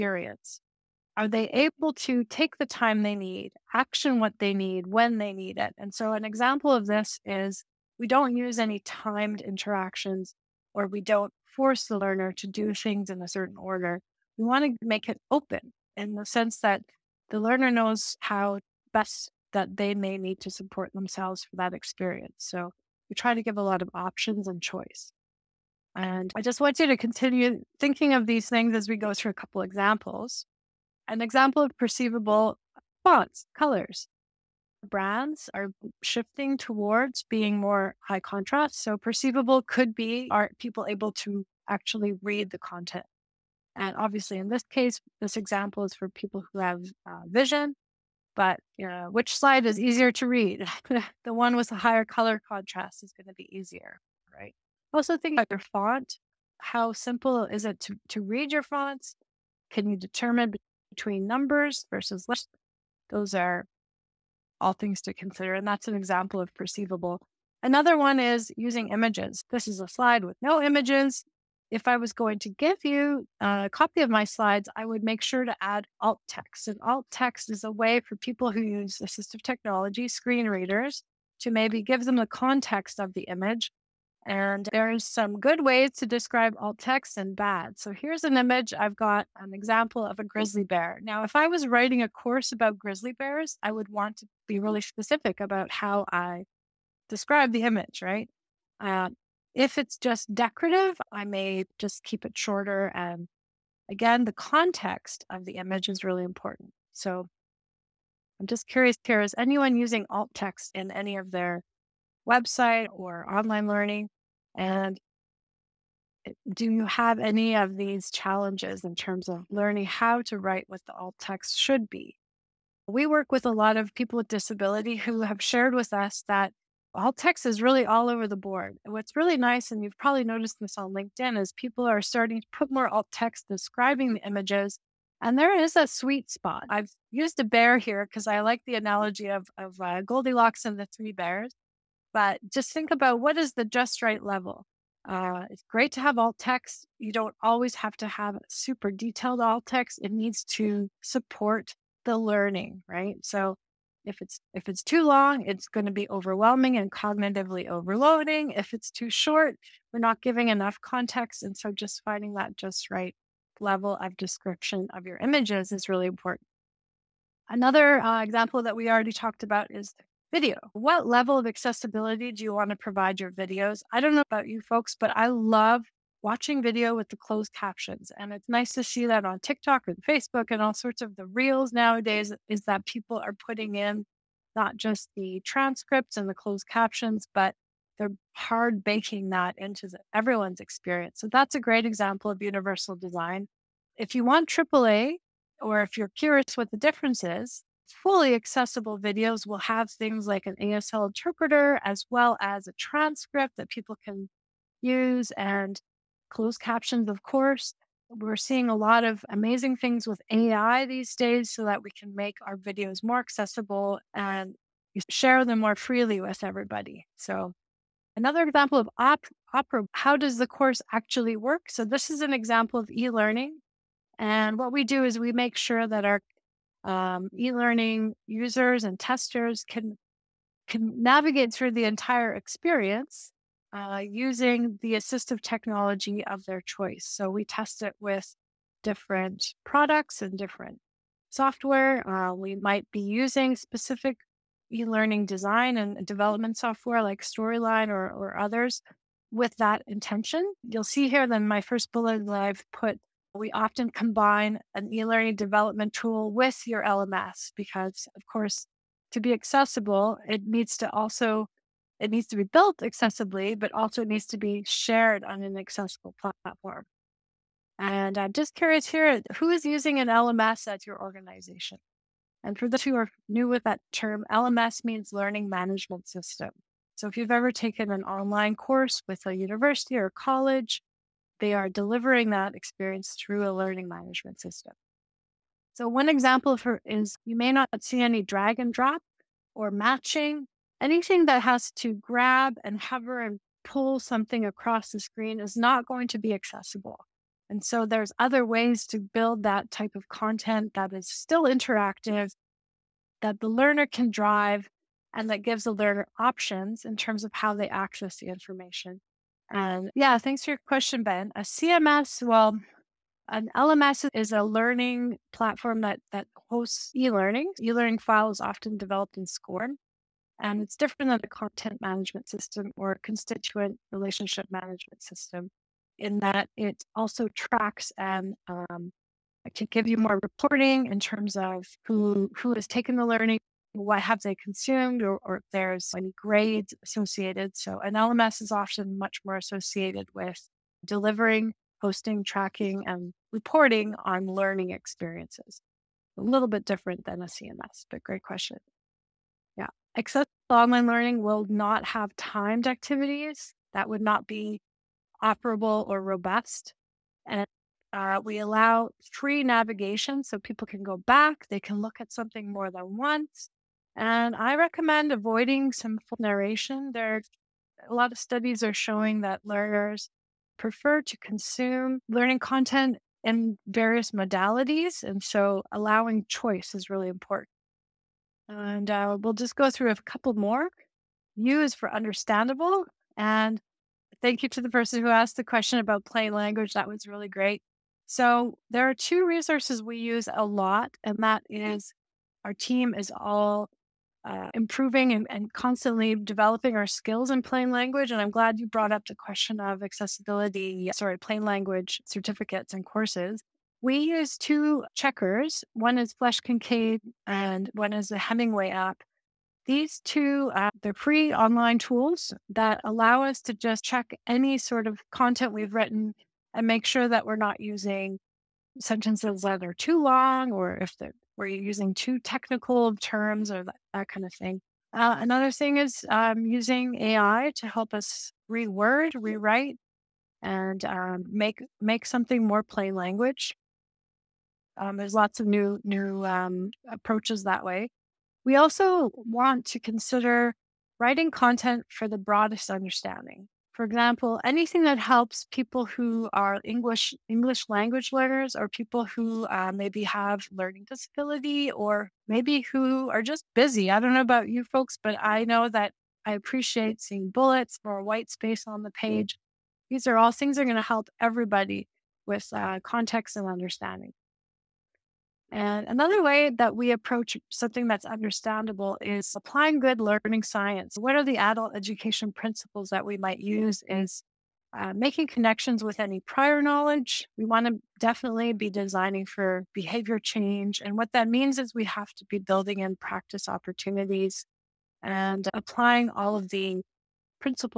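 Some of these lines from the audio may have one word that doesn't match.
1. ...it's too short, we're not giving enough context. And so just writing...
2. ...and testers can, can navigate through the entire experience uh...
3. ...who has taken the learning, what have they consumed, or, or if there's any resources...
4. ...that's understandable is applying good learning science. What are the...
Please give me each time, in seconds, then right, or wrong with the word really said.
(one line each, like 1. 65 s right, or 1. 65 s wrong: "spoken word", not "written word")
1. 158 s wrong: "finding", not "writing"
2. 228 s right
3. 332 s wrong: "grades", not "resources"
4. 467 s right.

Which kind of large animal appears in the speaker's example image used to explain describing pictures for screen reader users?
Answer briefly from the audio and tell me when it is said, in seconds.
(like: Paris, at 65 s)
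grizzly bear, at 90 s.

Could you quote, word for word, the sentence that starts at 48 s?
But uh, which slide is easier to read?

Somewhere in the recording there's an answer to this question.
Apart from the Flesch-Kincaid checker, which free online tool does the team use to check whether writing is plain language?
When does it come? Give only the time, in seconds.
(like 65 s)
408 s.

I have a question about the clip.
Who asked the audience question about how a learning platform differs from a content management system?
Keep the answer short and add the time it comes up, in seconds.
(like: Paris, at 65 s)
Ben, at 311 s.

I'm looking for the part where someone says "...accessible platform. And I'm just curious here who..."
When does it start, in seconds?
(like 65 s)
265 s.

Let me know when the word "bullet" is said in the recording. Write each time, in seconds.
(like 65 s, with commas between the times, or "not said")
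251 s, 457 s.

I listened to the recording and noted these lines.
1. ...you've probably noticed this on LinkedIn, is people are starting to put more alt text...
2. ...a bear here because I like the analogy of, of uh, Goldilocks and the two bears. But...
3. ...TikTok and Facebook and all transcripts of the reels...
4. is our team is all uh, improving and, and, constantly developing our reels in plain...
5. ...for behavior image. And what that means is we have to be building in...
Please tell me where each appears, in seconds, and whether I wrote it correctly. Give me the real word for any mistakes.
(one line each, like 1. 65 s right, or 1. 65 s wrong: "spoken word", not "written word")
1. 129 s right
2. 137 s wrong: "three", not "two"
3. 179 s wrong: "sorts", not "transcripts"
4. 391 s wrong: "skills", not "reels"
5. 479 s wrong: "change", not "image".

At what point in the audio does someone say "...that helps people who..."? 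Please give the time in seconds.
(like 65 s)
444 s.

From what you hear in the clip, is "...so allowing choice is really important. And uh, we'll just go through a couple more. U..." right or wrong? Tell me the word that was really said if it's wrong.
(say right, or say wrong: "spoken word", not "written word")
right.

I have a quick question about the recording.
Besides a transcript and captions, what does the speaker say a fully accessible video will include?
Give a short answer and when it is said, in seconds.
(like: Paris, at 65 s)
ASL interpreter, at 200 s.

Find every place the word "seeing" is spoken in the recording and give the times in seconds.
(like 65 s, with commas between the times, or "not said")
208 s, 457 s.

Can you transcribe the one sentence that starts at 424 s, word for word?
Uh, another thing is um, using AI to help us reword, rewrite, and um, make make something more plain language.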